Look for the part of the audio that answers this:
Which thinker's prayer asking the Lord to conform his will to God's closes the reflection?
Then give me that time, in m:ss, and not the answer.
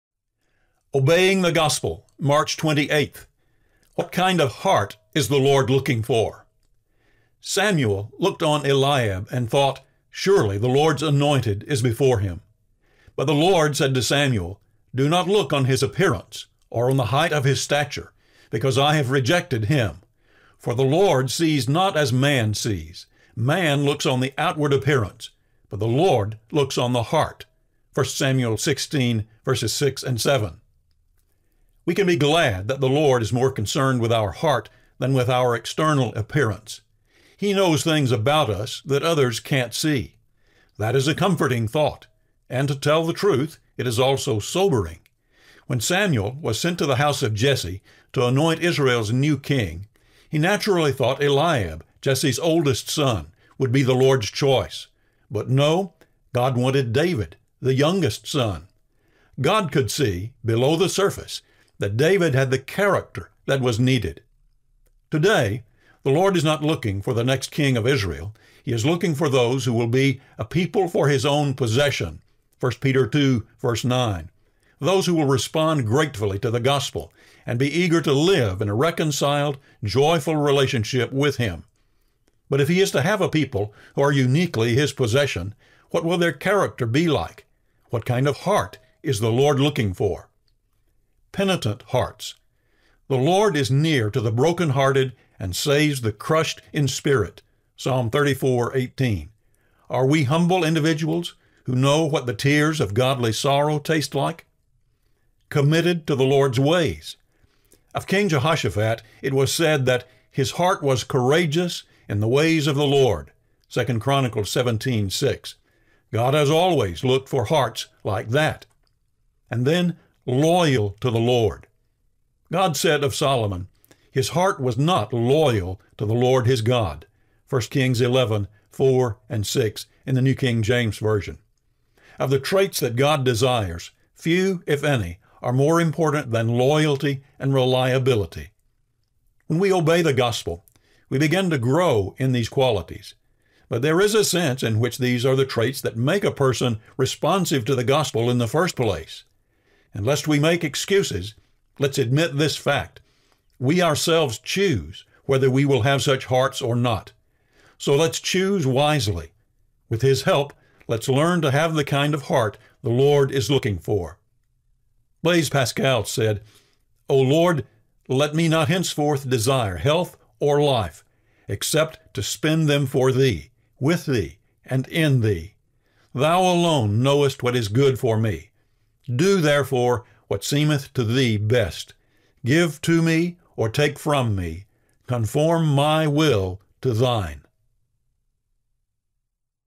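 2:45.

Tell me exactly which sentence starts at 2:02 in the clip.
God said of Solomon, his heart was not loyal to the Lord his God.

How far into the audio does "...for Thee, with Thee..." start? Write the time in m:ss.
2:52.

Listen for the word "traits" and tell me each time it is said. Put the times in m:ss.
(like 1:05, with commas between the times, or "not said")
2:12, 2:25.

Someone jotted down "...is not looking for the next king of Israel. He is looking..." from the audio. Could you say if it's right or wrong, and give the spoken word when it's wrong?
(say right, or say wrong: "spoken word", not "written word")
right.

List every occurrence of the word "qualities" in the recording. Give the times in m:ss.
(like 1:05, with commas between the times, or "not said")
2:22.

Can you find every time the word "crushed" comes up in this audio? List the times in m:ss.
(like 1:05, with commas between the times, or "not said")
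1:36.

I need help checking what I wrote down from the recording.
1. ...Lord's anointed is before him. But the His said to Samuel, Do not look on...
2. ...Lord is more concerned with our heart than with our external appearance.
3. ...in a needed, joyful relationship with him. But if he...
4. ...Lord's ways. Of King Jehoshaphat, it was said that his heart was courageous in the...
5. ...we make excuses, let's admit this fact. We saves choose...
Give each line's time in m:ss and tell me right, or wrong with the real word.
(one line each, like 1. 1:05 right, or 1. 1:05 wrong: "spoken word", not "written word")
1. 0:10 wrong: "Lord", not "His"
2. 0:32 right
3. 1:18 wrong: "reconciled", not "needed"
4. 1:46 right
5. 2:30 wrong: "ourselves", not "saves".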